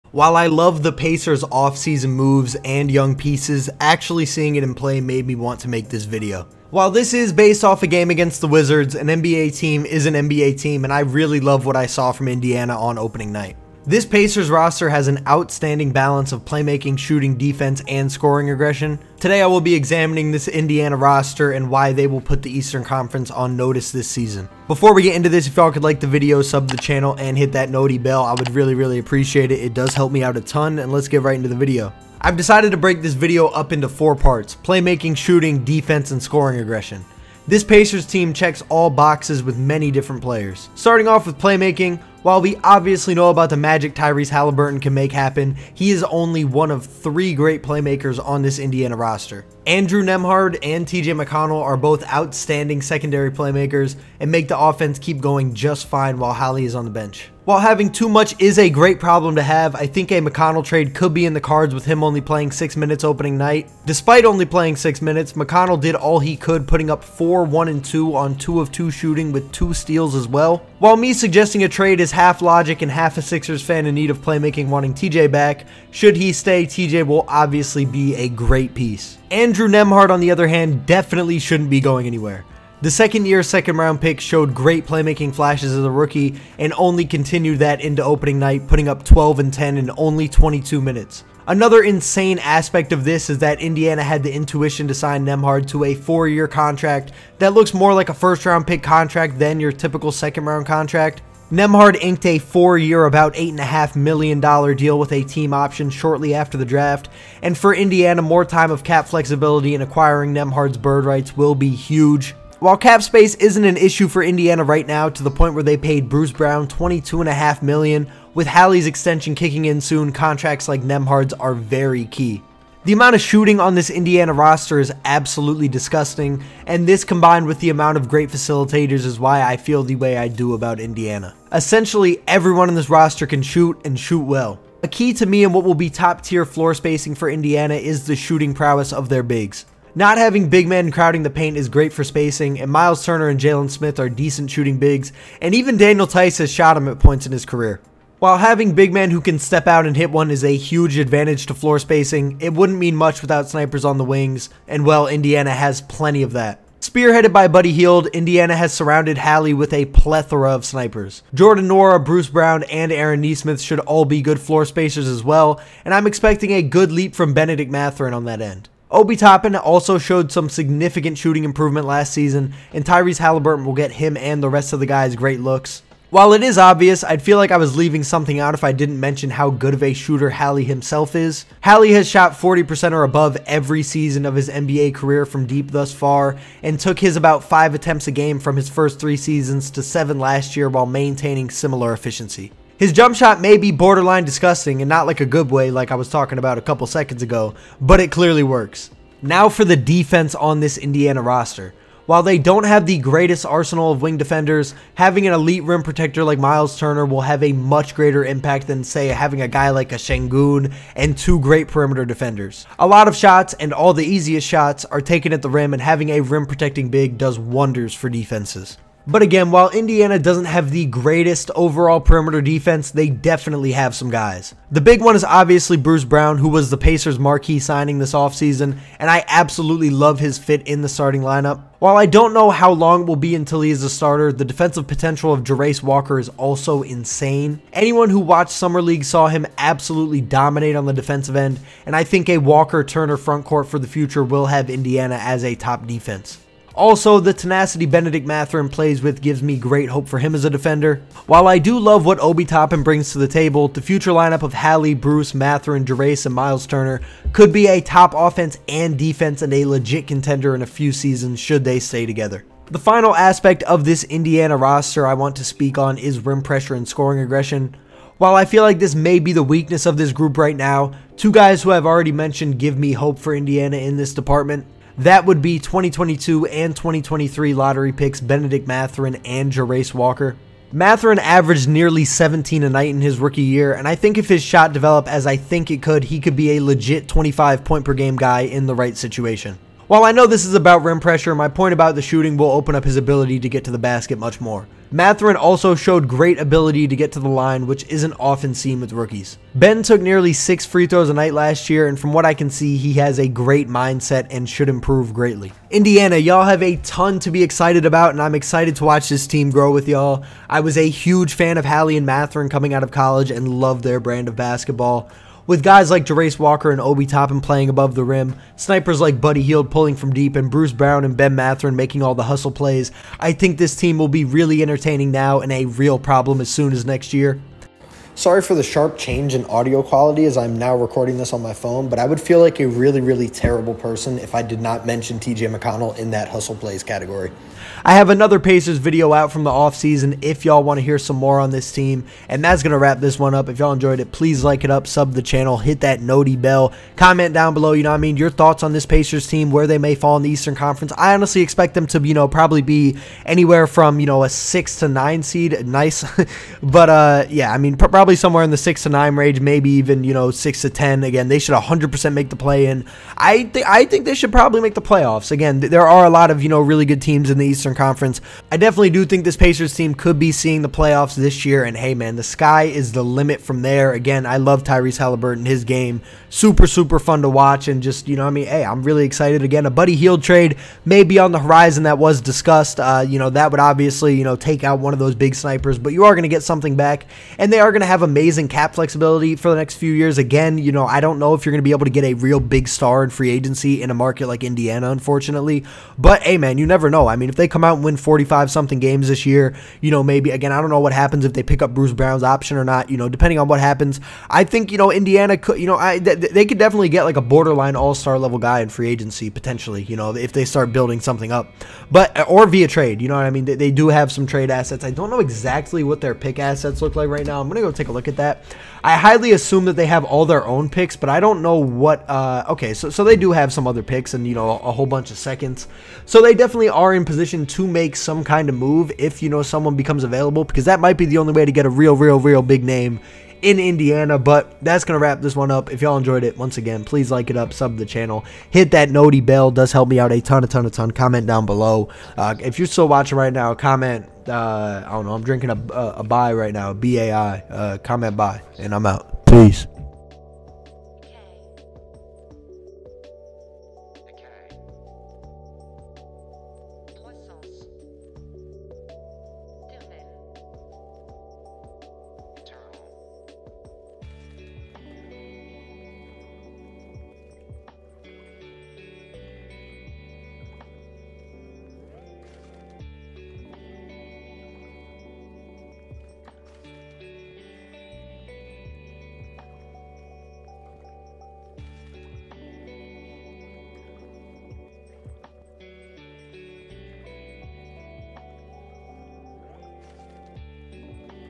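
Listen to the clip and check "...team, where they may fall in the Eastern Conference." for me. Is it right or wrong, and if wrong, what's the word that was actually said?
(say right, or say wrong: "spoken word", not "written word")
right.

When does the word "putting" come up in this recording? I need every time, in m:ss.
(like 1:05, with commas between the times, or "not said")
1:06, 1:28.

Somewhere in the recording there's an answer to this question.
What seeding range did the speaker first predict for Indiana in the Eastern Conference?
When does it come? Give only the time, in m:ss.
5:54.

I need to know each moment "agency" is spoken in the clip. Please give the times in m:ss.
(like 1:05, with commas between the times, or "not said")
6:33, 6:48.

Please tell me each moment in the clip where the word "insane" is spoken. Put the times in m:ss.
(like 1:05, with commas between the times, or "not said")
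1:31, 3:56.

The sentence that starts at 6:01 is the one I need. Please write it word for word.
Again, they should 100% make the play in.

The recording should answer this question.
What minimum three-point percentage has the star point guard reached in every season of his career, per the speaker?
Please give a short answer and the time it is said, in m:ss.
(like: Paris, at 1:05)
40%, at 3:02.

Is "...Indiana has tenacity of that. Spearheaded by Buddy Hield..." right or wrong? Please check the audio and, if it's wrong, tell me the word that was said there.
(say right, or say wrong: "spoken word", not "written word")
wrong: "plenty", not "tenacity".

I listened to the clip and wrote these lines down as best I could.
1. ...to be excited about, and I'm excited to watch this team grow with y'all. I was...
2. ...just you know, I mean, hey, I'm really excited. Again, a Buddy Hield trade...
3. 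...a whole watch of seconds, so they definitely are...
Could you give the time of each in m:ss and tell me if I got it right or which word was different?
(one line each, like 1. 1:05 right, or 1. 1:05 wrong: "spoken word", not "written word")
1. 5:07 right
2. 6:17 right
3. 7:04 wrong: "bunch", not "watch".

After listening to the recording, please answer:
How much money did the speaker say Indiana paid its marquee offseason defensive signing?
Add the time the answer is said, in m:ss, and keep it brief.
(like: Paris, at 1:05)
$22.5 million, at 1:56.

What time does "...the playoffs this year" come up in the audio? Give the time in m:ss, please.
6:10.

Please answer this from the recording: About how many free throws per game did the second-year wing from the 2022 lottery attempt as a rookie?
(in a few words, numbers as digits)
6.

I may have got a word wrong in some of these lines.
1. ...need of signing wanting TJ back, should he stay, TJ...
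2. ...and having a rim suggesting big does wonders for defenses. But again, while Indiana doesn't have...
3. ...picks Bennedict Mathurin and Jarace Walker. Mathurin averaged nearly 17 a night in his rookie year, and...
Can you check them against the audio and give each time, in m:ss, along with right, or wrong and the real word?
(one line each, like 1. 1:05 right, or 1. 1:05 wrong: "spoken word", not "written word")
1. 1:13 wrong: "playmaking", not "signing"
2. 3:35 wrong: "protecting", not "suggesting"
3. 4:37 right.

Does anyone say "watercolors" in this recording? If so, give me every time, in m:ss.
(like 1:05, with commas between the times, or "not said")
not said.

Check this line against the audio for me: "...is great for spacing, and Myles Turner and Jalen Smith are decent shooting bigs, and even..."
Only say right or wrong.
right.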